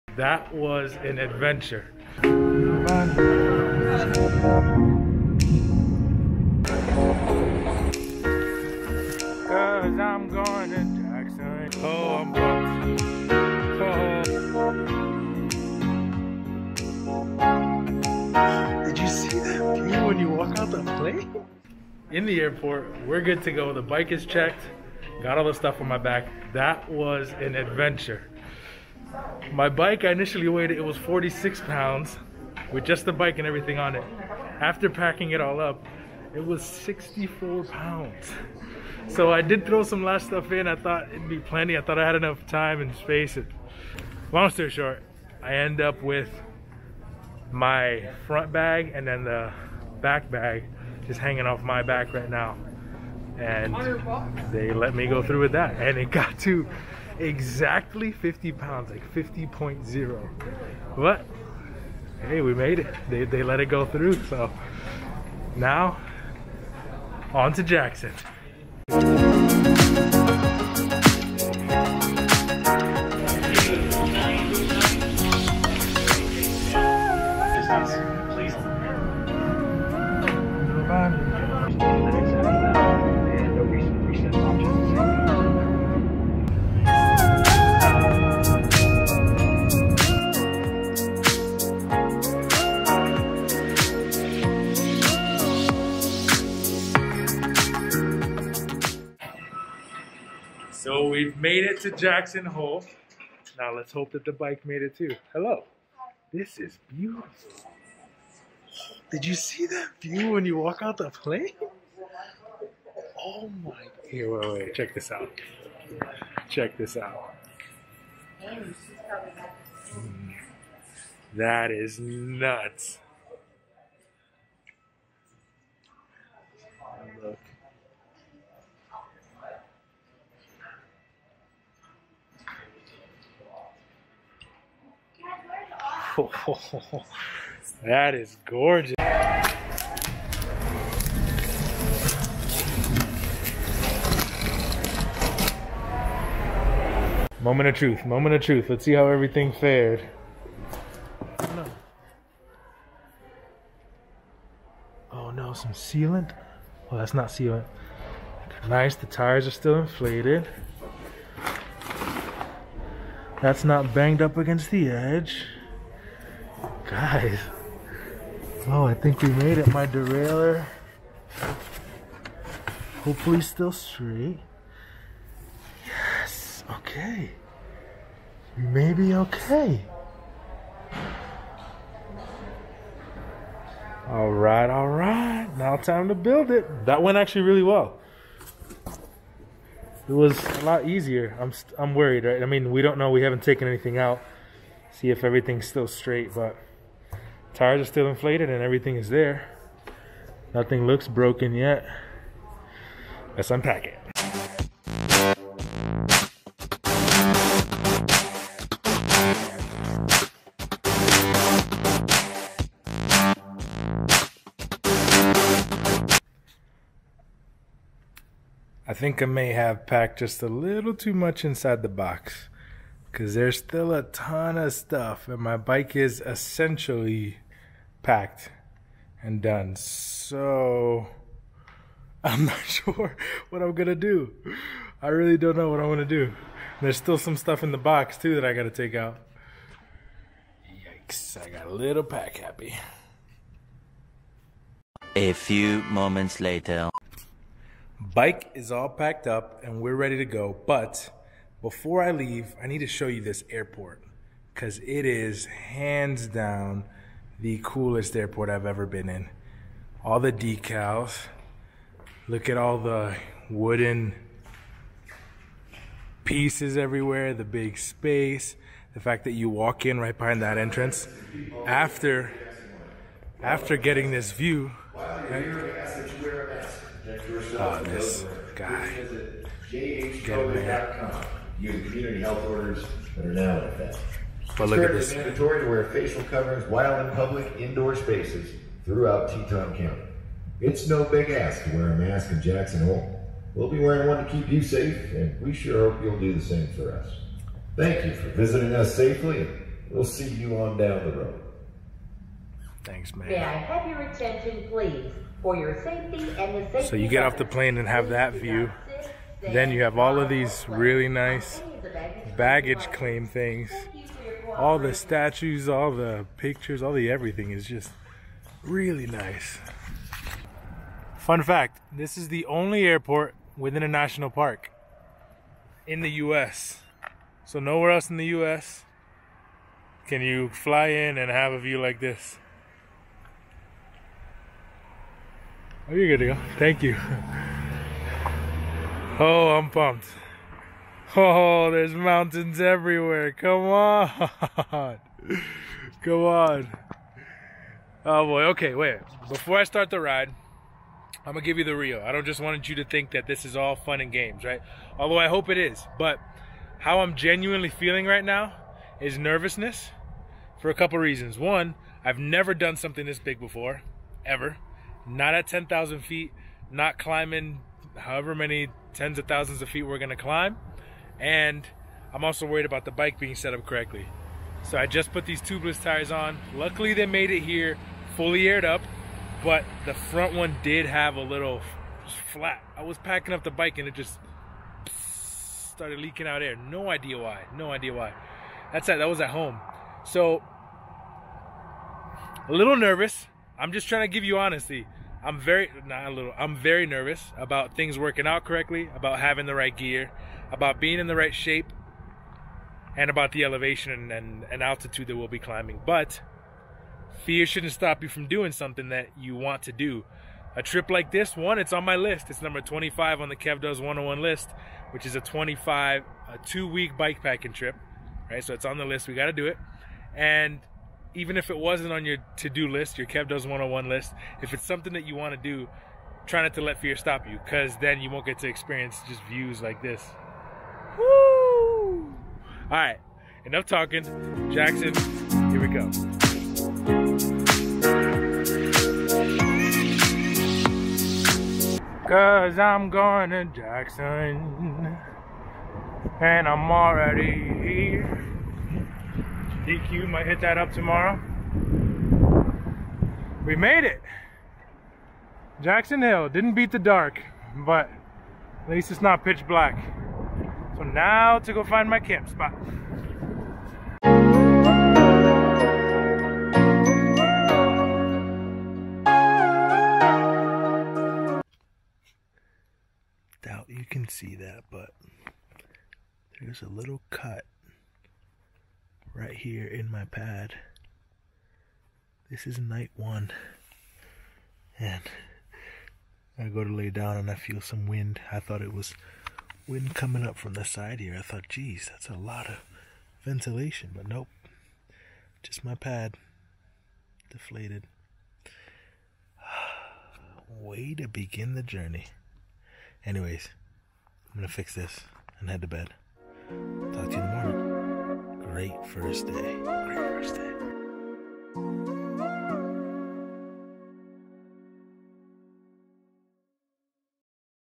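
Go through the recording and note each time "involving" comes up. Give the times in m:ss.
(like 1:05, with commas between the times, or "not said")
not said.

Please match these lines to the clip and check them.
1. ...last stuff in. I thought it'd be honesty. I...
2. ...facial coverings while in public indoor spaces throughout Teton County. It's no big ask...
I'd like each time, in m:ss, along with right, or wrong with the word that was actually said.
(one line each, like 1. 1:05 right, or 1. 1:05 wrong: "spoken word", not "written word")
1. 0:40 wrong: "plenty", not "honesty"
2. 4:45 right.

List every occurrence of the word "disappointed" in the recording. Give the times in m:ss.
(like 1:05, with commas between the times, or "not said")
not said.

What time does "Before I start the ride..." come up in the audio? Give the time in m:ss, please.
5:49.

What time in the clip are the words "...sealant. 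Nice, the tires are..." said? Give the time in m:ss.
2:37.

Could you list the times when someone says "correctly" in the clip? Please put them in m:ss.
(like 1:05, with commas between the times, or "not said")
6:13, 6:38.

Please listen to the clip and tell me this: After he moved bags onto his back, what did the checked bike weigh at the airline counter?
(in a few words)
50.0 pounds.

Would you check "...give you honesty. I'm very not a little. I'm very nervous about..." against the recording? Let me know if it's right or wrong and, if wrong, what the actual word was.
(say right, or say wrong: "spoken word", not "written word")
right.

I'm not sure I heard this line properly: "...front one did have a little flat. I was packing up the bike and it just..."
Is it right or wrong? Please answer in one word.
right.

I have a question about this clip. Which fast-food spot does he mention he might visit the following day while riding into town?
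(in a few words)
DQ.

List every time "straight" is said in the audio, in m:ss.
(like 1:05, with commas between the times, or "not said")
2:53, 3:15.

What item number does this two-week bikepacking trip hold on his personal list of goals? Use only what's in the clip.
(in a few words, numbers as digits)
25.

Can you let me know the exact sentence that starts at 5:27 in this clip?
So nowhere else in the US can you fly in and have a view like this.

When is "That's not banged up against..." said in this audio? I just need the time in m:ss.
2:43.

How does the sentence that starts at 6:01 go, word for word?
One, I've never done something this big before, ever.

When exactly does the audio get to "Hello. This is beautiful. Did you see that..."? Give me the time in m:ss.
1:45.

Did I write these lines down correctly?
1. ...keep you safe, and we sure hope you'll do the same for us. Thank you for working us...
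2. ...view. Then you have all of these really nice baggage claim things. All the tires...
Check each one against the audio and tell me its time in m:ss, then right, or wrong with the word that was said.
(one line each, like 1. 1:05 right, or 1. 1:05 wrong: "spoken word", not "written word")
1. 4:54 wrong: "visiting", not "working"
2. 5:08 wrong: "statues", not "tires".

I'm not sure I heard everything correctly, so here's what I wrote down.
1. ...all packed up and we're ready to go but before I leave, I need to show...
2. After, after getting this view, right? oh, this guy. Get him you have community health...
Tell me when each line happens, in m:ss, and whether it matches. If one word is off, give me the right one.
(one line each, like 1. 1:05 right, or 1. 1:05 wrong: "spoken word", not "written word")
1. 4:08 right
2. 4:31 right.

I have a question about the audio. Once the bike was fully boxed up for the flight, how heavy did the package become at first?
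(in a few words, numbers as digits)
64 pounds.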